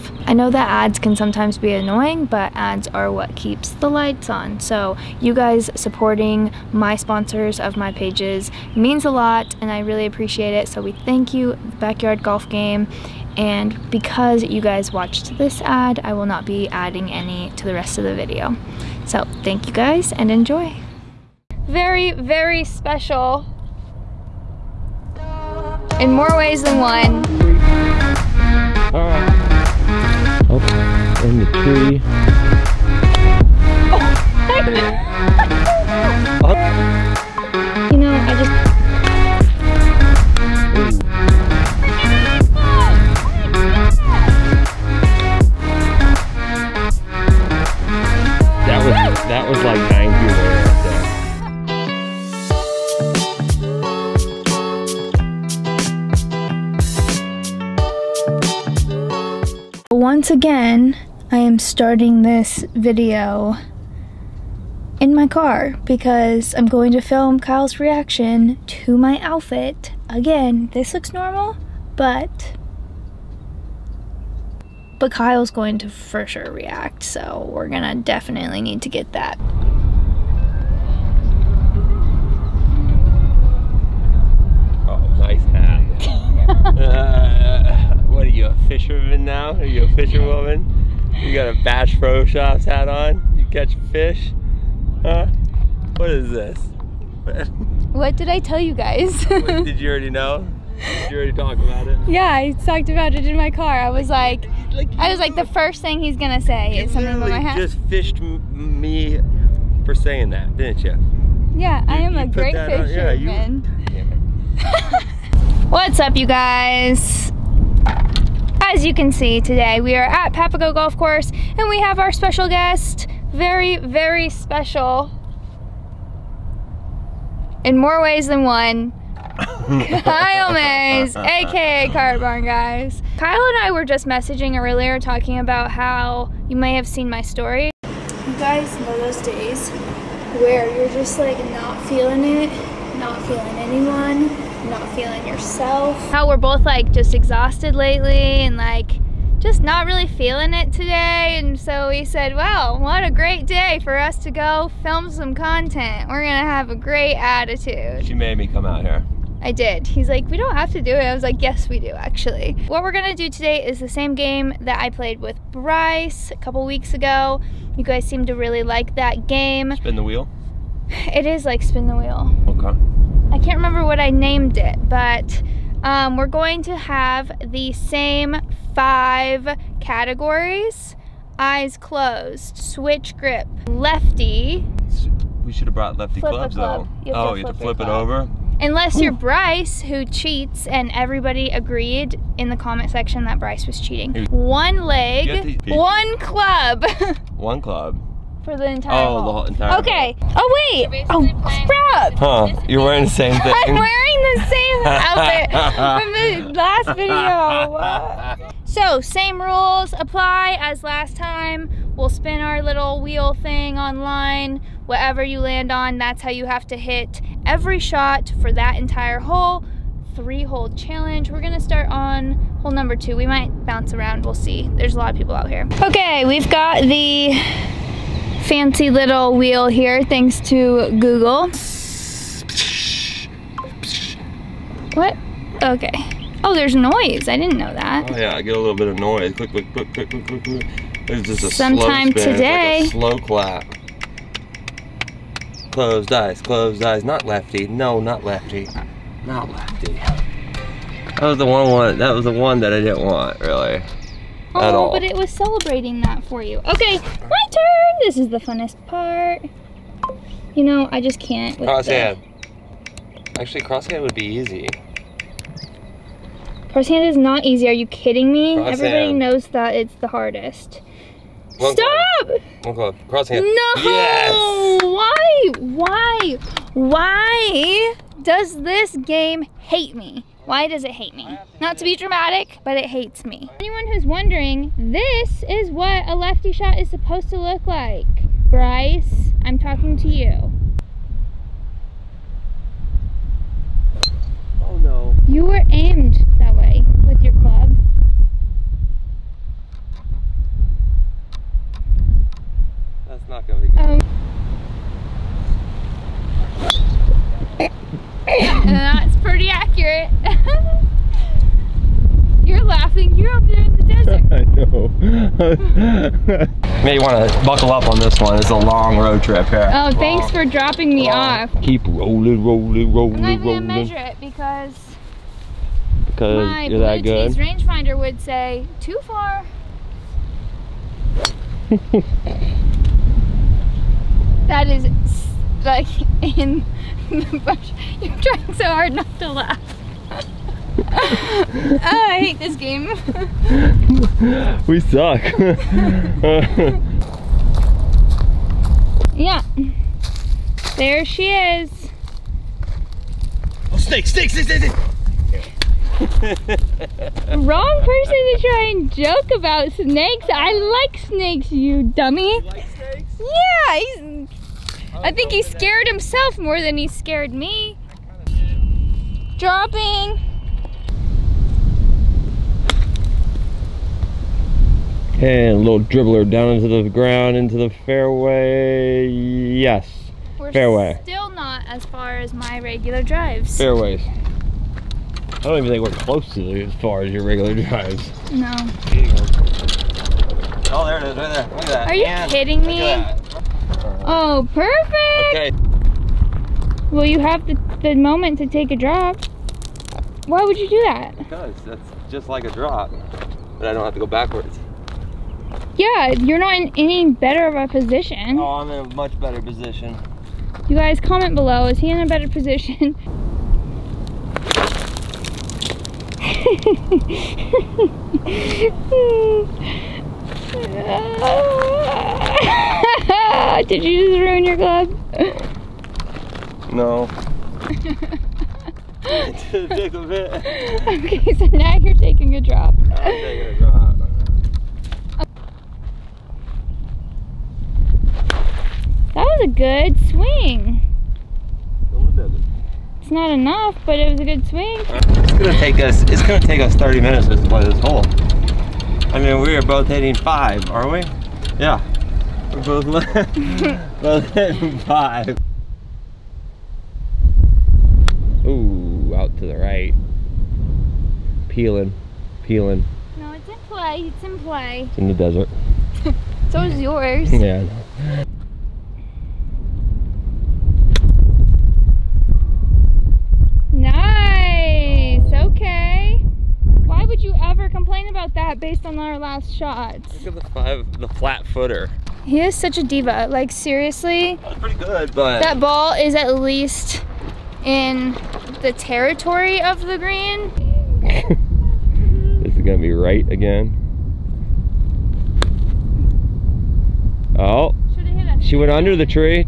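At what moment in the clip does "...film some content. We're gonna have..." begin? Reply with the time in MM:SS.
02:34.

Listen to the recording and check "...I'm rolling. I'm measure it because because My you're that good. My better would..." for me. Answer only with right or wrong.
wrong.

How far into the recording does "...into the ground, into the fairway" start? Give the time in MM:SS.
06:16.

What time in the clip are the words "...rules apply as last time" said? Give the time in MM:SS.
03:29.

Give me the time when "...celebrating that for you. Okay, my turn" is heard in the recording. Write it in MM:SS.
04:15.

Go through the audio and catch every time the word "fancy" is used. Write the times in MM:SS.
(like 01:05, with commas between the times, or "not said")
03:48.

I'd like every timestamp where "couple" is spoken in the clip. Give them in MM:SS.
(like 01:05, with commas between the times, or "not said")
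02:46.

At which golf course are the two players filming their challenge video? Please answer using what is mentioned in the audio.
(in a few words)
Papago Golf Course.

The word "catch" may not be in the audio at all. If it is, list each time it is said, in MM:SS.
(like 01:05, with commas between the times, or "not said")
01:33.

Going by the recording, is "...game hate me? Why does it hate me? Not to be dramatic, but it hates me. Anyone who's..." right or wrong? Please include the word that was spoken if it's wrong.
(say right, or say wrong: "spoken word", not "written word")
right.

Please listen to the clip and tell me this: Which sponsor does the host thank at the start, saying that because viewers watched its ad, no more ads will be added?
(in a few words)
Backyard Golf Game.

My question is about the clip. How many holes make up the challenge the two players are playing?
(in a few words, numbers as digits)
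3.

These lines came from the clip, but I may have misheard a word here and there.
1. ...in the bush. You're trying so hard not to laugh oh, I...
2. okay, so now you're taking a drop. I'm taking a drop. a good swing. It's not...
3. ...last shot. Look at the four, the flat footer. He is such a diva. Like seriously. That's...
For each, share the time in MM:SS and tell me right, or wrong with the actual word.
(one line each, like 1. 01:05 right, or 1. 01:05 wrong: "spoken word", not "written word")
1. 05:36 right
2. 07:10 right
3. 07:59 wrong: "five", not "four".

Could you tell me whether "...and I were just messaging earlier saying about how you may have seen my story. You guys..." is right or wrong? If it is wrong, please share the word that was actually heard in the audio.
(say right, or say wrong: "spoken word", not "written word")
wrong: "talking", not "saying".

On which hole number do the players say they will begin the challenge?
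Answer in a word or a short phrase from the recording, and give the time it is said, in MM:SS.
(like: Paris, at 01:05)
2, at 03:42.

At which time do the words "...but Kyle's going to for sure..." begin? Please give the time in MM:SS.
01:14.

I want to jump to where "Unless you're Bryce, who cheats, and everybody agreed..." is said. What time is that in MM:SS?
03:08.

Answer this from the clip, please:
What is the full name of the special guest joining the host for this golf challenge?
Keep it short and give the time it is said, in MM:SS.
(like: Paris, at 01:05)
Kyle Mays, at 02:09.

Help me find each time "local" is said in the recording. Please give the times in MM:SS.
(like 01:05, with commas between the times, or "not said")
not said.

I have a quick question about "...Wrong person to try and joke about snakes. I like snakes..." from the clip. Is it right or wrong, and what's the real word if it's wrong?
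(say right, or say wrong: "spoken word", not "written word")
right.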